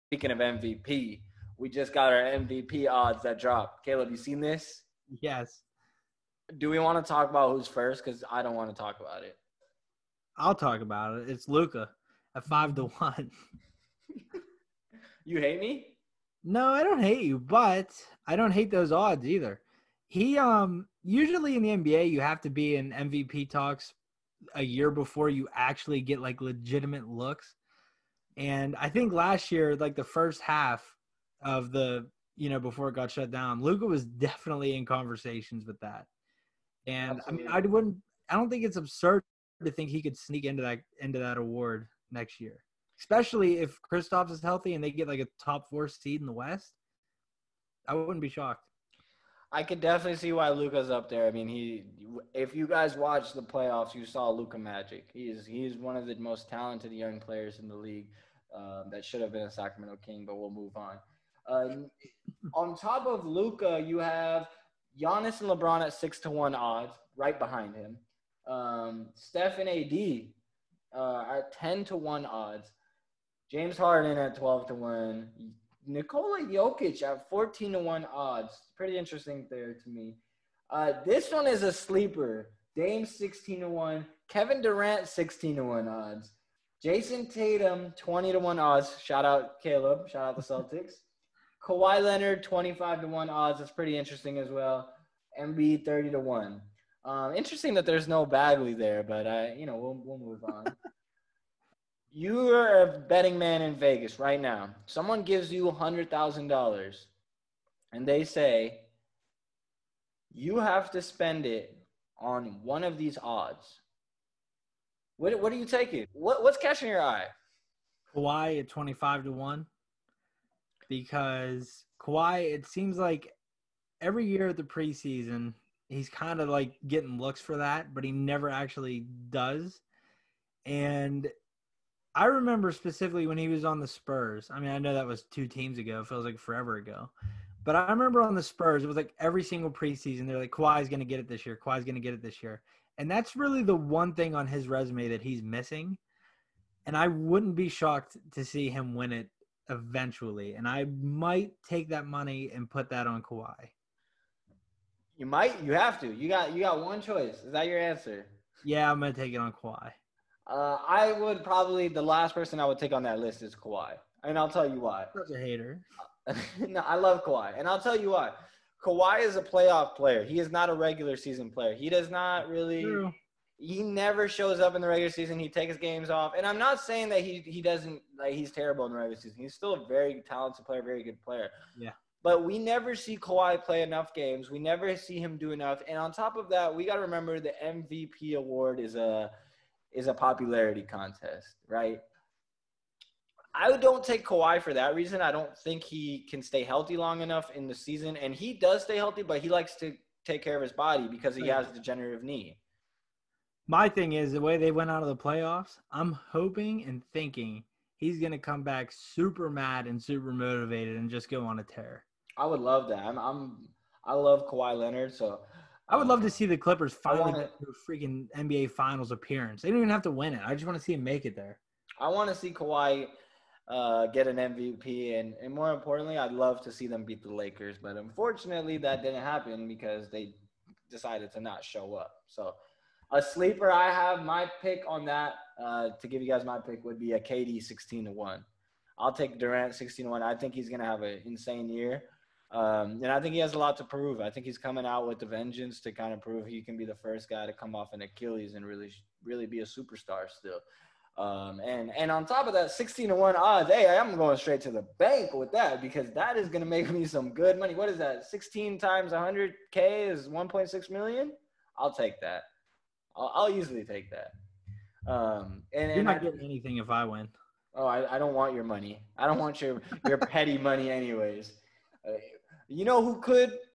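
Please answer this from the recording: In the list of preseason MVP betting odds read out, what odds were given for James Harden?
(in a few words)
12 to 1.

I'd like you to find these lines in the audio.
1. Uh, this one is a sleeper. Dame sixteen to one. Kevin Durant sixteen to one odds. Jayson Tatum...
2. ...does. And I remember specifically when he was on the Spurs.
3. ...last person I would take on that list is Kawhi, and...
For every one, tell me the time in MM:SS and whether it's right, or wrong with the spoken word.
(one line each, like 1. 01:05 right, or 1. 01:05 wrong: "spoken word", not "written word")
1. 01:20 right
2. 02:09 right
3. 02:42 right.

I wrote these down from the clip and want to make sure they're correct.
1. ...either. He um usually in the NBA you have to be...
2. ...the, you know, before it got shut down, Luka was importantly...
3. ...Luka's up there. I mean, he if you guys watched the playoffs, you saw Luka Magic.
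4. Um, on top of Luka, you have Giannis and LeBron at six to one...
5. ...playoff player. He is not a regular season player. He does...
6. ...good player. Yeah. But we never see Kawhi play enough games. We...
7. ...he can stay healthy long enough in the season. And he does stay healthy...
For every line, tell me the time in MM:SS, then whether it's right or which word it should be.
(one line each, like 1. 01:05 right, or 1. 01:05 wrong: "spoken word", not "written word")
1. 00:19 right
2. 00:31 wrong: "definitely", not "importantly"
3. 00:50 right
4. 01:01 right
5. 02:49 right
6. 03:01 right
7. 03:15 right.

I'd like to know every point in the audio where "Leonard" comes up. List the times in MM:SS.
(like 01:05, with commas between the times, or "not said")
01:32, 03:34.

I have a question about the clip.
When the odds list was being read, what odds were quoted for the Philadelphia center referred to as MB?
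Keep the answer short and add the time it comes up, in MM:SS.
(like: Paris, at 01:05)
30 to 1, at 01:35.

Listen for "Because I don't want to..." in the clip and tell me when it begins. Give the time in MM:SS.
00:08.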